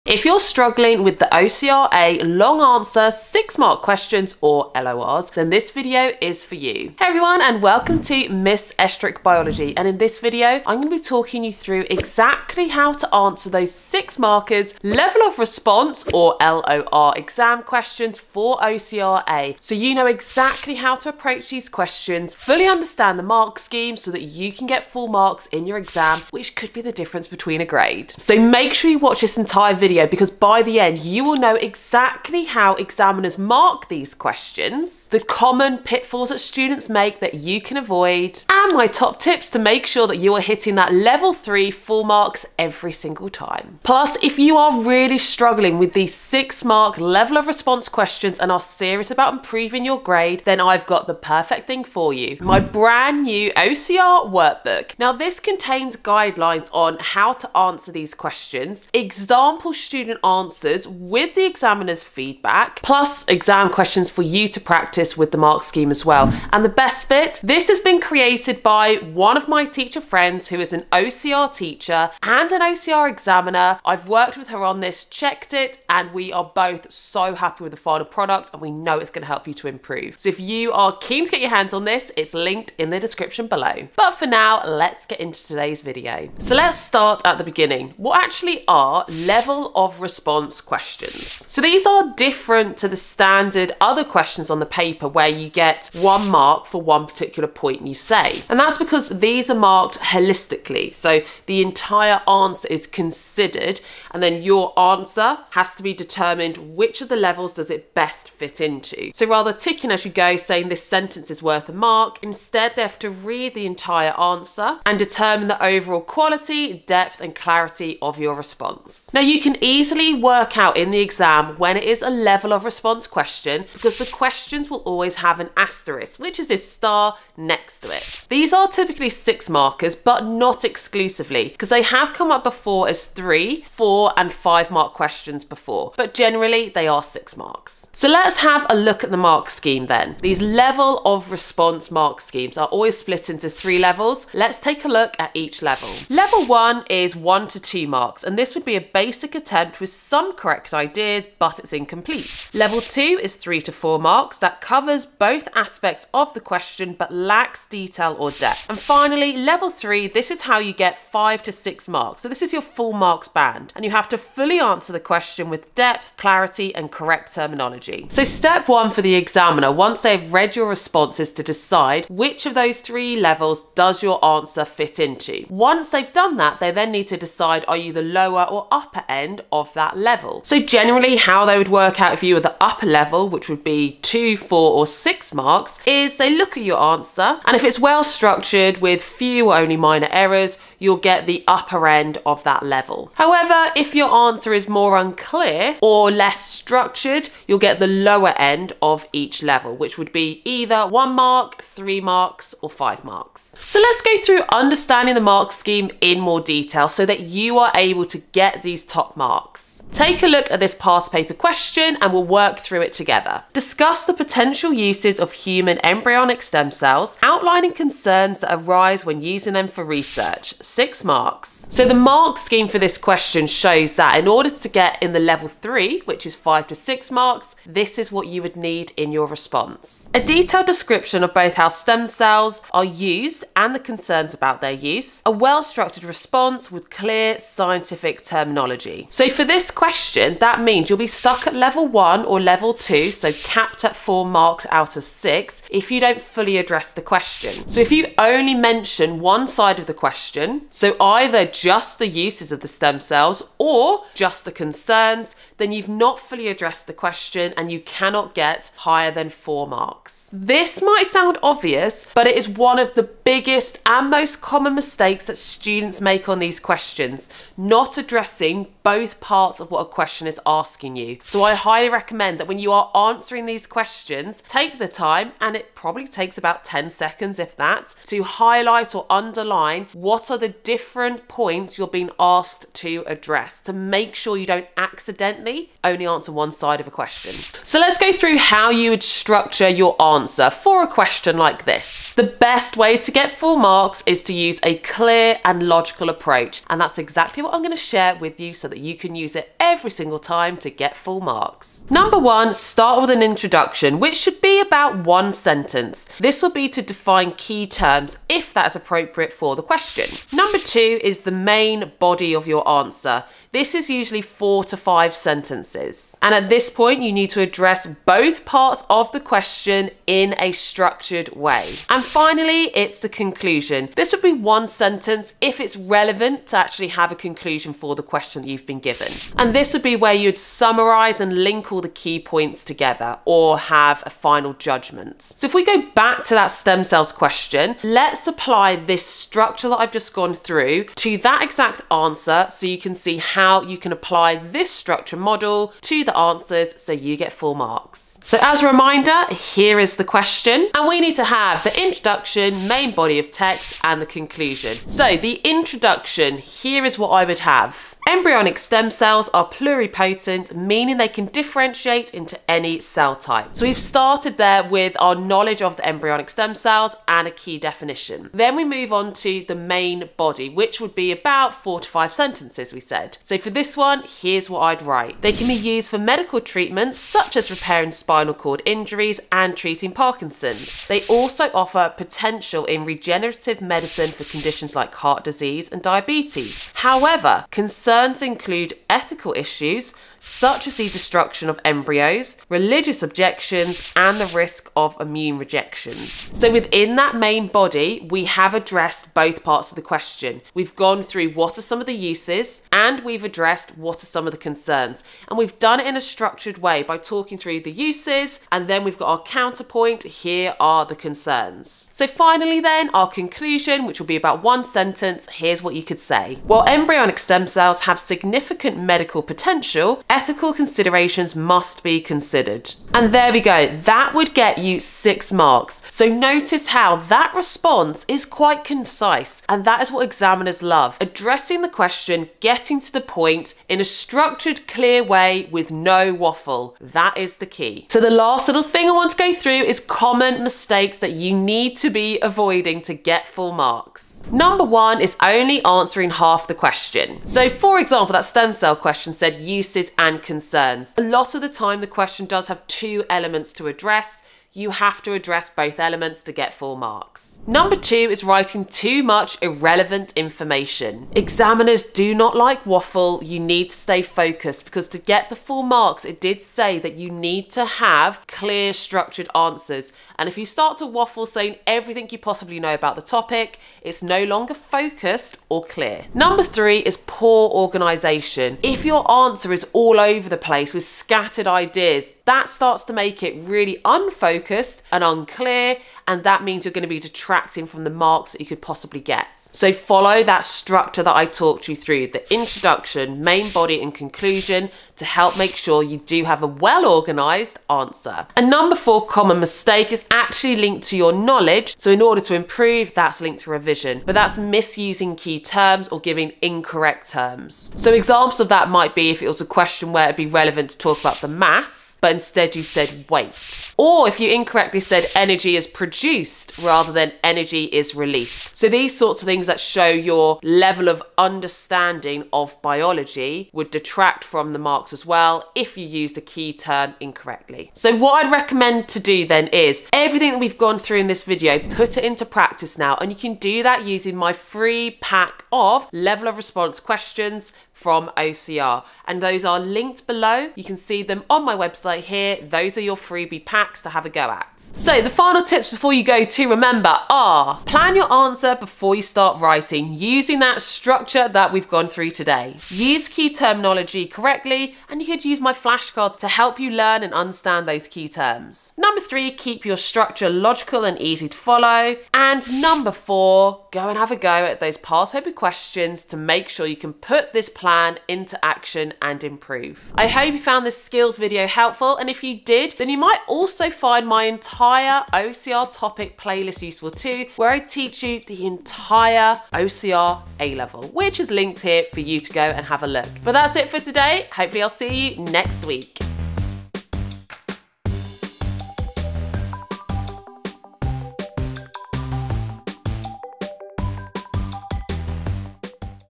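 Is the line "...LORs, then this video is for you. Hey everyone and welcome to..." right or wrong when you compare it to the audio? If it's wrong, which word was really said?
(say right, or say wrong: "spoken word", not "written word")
right.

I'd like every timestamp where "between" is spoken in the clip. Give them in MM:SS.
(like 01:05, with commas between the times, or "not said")
00:27.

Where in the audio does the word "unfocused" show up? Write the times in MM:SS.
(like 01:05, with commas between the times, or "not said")
08:03.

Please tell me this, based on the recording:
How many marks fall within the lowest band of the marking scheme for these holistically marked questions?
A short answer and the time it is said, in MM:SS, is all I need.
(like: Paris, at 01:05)
1 to 2, at 02:27.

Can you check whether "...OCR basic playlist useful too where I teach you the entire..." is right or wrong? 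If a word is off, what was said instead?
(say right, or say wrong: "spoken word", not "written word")
wrong: "topic", not "basic".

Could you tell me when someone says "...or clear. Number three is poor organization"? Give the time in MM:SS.
07:55.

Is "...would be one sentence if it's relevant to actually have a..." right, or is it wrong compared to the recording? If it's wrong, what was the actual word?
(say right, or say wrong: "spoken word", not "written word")
right.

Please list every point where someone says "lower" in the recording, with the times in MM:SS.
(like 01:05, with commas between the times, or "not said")
02:58, 03:17.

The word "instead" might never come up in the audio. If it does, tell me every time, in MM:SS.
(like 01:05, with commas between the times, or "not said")
01:52, 08:32.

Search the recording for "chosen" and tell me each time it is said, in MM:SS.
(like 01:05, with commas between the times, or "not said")
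not said.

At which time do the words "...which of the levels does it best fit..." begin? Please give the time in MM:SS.
01:46.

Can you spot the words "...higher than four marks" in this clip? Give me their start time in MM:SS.
04:18.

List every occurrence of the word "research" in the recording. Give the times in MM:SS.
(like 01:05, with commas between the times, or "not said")
03:39.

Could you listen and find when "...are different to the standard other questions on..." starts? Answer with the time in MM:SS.
01:31.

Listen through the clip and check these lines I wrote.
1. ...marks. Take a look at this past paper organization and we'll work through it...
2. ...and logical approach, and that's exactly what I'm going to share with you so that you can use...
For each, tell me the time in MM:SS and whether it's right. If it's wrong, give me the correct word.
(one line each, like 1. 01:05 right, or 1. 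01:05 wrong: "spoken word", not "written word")
1. 03:29 wrong: "question", not "organization"
2. 04:55 right.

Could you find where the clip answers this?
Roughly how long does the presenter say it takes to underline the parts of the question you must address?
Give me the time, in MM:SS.
04:36.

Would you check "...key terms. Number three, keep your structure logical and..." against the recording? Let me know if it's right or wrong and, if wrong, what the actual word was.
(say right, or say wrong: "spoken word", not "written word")
right.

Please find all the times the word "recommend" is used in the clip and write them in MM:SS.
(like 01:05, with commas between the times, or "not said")
04:31, 08:48.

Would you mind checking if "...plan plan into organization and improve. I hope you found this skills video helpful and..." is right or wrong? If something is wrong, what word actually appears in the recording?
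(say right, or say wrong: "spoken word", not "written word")
wrong: "action", not "organization".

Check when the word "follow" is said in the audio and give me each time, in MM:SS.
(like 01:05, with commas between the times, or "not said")
08:09, 09:21.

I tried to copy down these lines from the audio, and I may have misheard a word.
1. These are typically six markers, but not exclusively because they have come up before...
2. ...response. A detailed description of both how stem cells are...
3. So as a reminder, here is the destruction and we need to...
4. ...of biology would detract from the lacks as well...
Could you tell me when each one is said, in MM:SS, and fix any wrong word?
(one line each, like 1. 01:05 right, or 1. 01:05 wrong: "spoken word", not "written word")
1. 02:08 right
2. 03:49 right
3. 05:48 wrong: "question", not "destruction"
4. 08:42 wrong: "marks", not "lacks".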